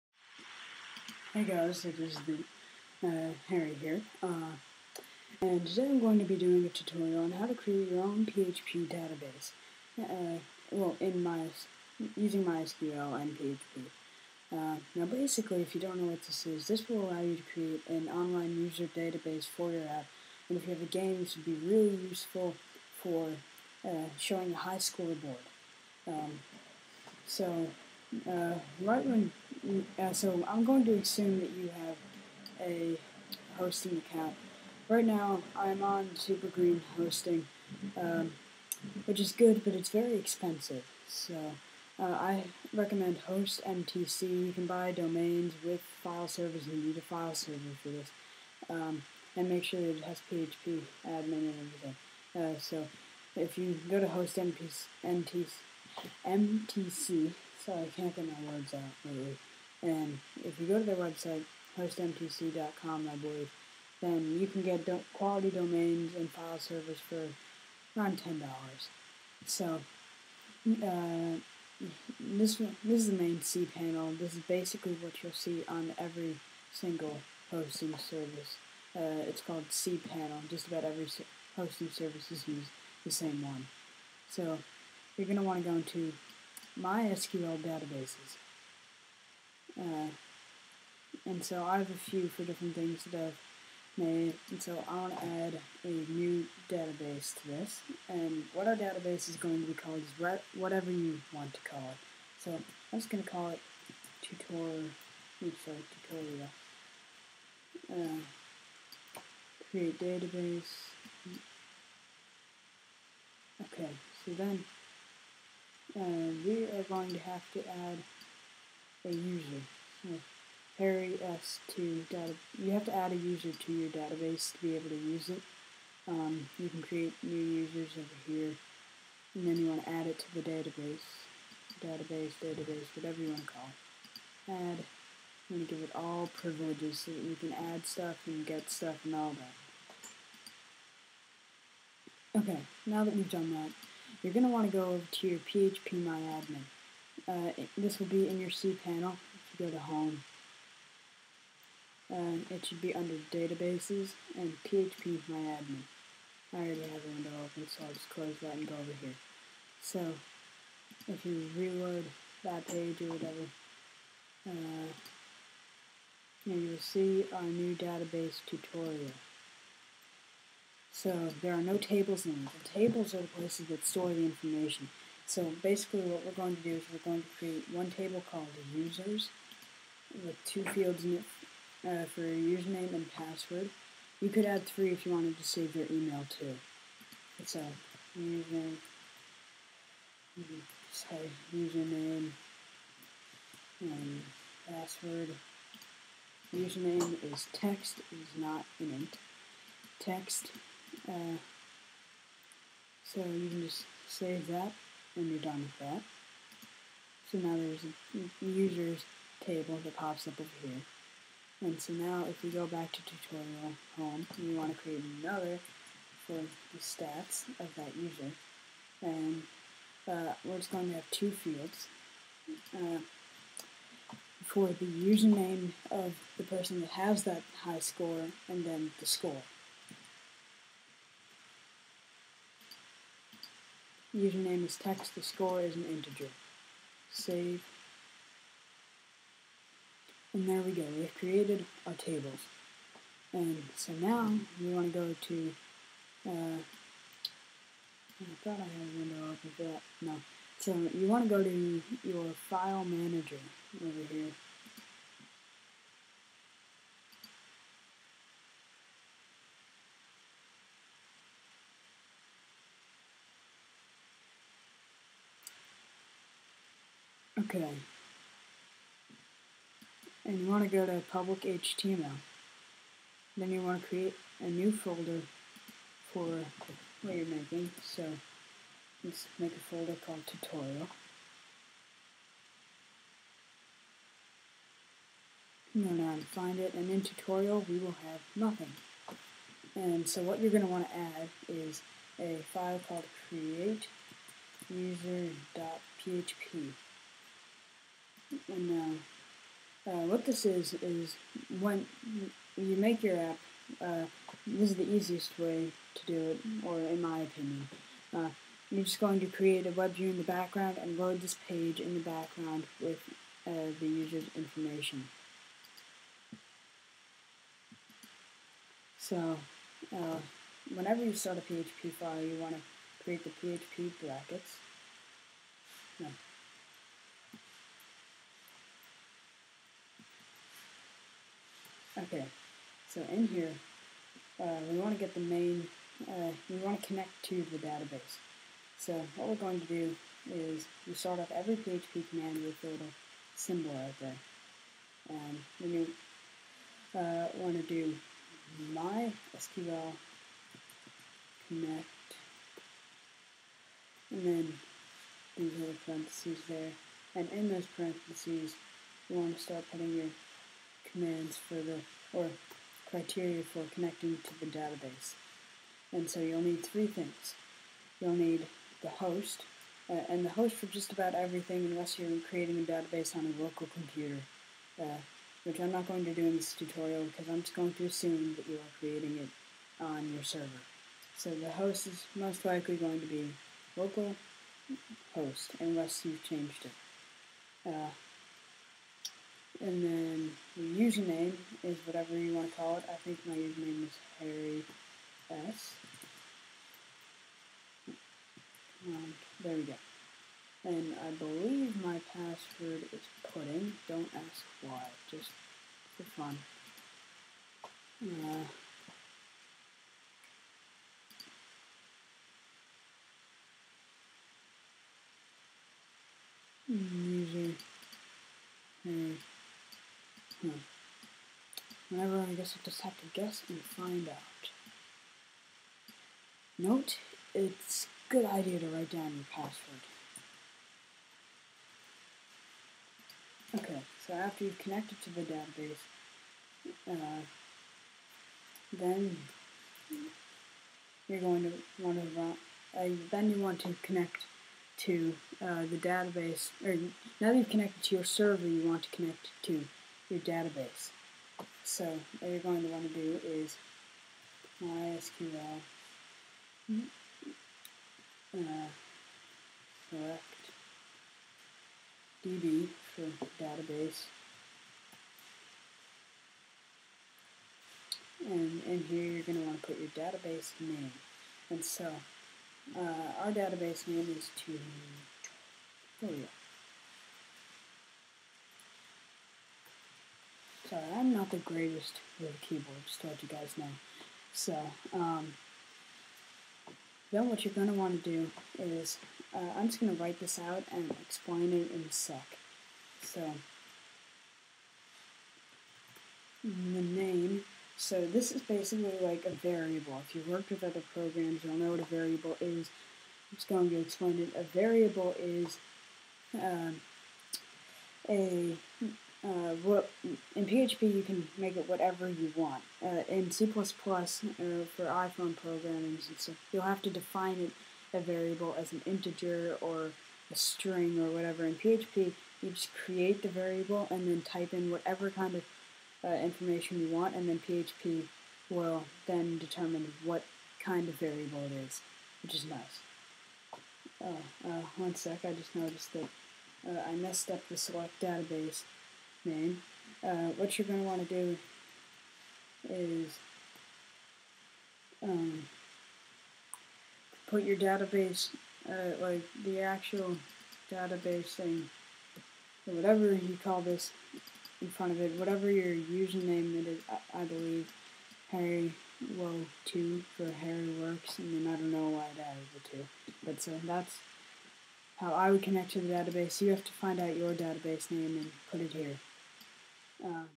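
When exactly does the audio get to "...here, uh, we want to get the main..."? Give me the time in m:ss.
5:33.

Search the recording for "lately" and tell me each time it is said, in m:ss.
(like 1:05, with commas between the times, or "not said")
0:59.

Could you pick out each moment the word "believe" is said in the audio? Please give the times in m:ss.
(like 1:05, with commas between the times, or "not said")
1:03, 6:41, 9:17.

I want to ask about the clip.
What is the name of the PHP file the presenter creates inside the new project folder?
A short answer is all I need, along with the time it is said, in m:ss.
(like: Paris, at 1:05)
create user.php, at 4:53.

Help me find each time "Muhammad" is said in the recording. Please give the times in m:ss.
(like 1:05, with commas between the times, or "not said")
not said.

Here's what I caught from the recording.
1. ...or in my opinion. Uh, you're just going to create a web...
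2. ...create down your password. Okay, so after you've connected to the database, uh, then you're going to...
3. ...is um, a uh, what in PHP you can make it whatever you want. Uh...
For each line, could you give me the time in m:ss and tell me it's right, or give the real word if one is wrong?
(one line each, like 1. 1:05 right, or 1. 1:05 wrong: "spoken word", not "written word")
1. 5:06 right
2. 7:08 wrong: "write", not "create"
3. 8:25 right.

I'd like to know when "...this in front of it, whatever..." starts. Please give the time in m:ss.
9:13.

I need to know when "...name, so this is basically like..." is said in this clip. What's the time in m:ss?
8:16.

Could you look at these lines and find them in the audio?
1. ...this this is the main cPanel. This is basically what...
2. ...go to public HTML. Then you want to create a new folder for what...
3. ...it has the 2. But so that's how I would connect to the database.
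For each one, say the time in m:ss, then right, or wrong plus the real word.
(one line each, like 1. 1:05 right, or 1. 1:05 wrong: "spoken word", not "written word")
1. 1:12 right
2. 4:30 right
3. 9:22 right.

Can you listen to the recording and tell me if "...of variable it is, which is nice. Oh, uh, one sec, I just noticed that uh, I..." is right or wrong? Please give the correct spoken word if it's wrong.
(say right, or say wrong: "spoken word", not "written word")
right.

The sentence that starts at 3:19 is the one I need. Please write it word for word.
Text uh, so you can just save that and you're done with that.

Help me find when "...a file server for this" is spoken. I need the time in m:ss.
0:46.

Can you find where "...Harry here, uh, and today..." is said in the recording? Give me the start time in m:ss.
0:03.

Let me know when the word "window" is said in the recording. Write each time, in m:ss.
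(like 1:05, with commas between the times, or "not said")
2:37, 4:08.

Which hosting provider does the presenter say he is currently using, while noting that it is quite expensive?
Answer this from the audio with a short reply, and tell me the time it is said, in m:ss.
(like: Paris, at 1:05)
Supergreen hosting, at 0:36.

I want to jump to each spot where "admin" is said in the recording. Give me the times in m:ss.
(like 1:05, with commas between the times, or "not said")
0:51, 2:26, 2:35.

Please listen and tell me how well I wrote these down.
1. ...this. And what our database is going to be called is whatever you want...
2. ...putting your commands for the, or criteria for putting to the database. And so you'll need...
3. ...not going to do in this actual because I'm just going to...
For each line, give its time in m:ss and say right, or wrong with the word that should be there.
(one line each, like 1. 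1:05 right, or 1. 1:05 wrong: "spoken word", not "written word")
1. 1:37 right
2. 5:59 wrong: "connecting", not "putting"
3. 6:15 wrong: "tutorial", not "actual".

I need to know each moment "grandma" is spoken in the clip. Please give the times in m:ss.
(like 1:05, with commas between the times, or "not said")
not said.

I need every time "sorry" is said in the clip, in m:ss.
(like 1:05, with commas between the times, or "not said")
0:57, 1:45, 3:10.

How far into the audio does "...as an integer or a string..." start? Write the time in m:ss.
8:38.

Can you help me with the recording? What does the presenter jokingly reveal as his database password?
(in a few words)
pudding.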